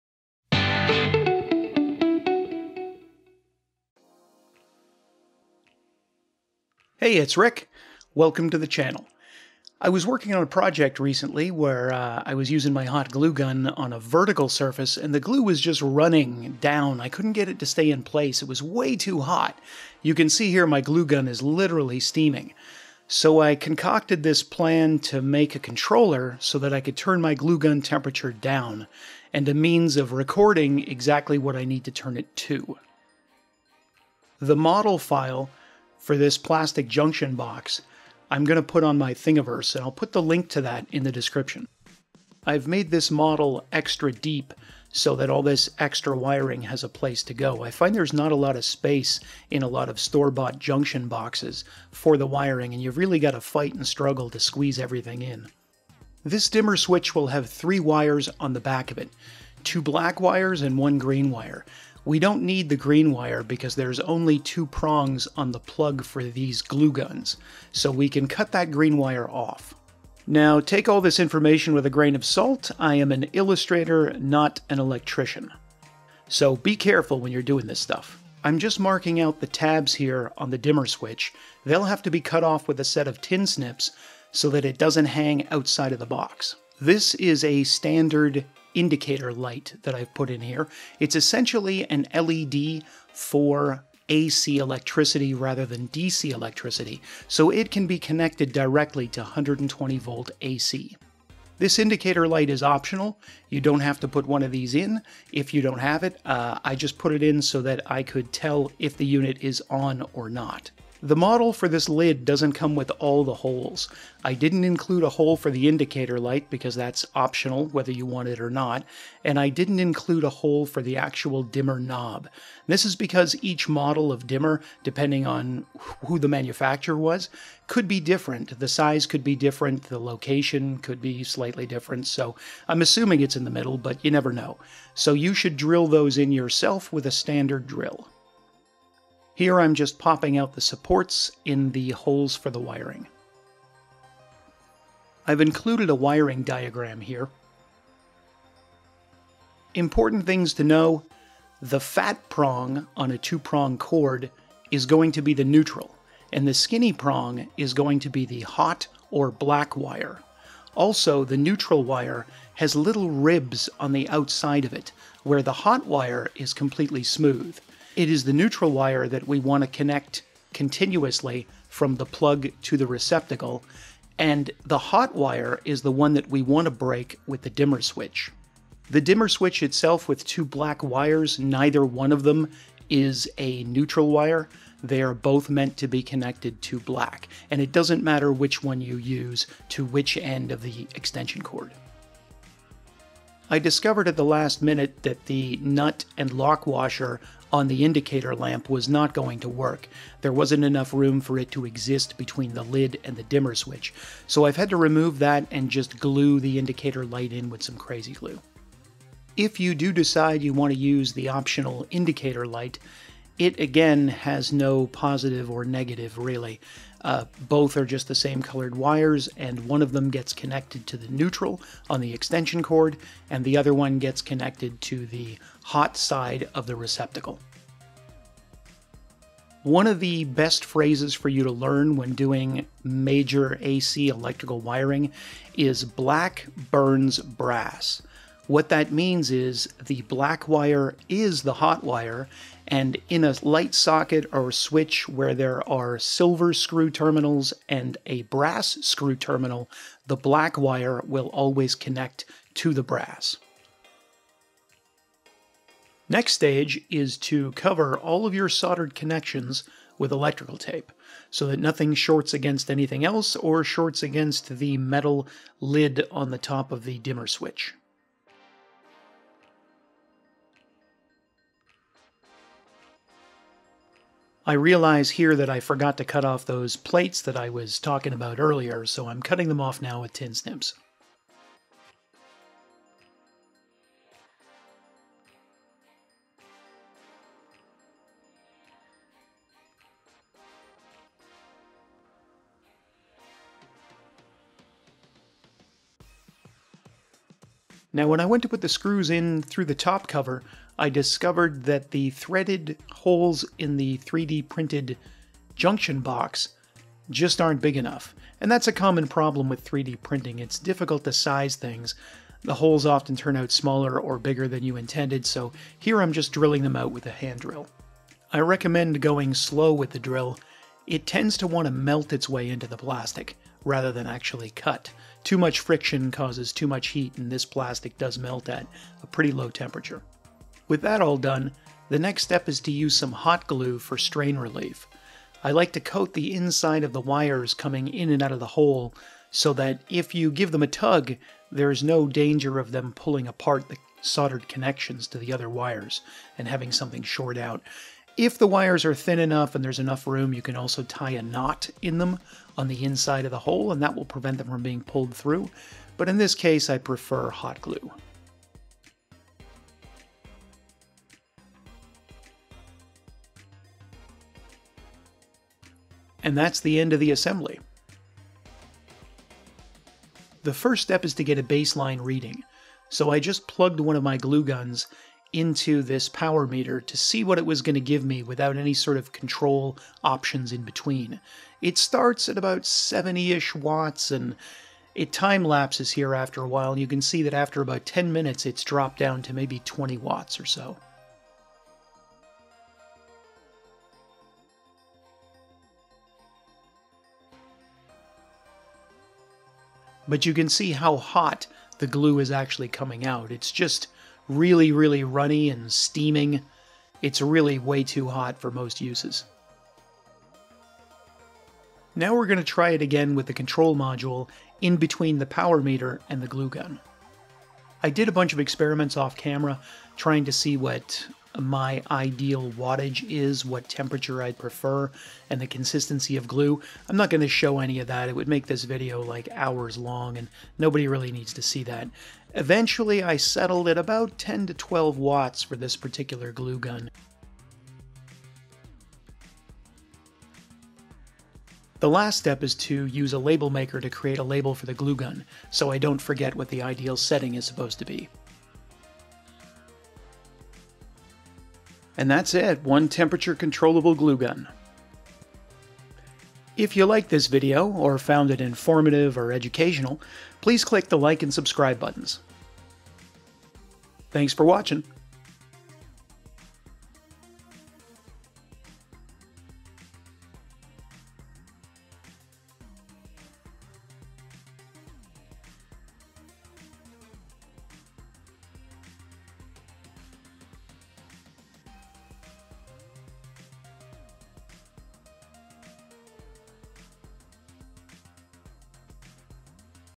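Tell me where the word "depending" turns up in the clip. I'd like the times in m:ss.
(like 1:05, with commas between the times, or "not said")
2:04.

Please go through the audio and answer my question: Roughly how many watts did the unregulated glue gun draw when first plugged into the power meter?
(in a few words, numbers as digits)
70.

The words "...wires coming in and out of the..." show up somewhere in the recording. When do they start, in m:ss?
5:37.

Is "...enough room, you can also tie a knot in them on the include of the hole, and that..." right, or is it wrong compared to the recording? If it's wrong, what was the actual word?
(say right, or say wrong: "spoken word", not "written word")
wrong: "inside", not "include".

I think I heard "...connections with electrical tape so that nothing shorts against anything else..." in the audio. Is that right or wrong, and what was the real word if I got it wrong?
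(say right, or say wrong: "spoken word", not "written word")
right.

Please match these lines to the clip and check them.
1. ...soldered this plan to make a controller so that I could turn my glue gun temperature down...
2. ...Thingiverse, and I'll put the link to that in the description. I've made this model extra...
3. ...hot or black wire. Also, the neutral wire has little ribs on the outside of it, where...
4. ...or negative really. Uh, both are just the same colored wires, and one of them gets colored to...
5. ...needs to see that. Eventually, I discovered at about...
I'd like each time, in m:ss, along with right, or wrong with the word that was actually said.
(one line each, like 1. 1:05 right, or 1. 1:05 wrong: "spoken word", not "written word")
1. 0:23 wrong: "concocted", not "soldered"
2. 0:39 right
3. 2:38 right
4. 3:35 wrong: "connected", not "colored"
5. 7:11 wrong: "settled", not "discovered".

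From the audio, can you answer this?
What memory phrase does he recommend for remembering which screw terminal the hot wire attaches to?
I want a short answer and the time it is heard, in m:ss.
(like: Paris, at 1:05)
Black burns brass, at 3:55.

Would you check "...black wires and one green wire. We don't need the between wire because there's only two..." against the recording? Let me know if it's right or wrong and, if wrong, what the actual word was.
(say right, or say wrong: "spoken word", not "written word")
wrong: "green", not "between".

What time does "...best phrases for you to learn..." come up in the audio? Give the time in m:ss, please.
3:50.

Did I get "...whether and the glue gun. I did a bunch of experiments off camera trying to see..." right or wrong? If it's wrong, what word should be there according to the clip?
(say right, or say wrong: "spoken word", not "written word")
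wrong: "meter", not "whether".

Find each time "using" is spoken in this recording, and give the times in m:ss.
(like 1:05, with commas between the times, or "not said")
0:12.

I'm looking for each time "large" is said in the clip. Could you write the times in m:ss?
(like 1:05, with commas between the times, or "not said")
not said.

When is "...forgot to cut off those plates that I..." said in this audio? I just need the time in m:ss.
4:35.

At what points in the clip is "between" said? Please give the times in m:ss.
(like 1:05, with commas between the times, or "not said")
3:22, 6:20, 6:54.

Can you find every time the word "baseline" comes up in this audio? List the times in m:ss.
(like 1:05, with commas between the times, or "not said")
6:11.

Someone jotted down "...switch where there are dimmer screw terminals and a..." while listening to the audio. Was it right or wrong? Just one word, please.
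wrong.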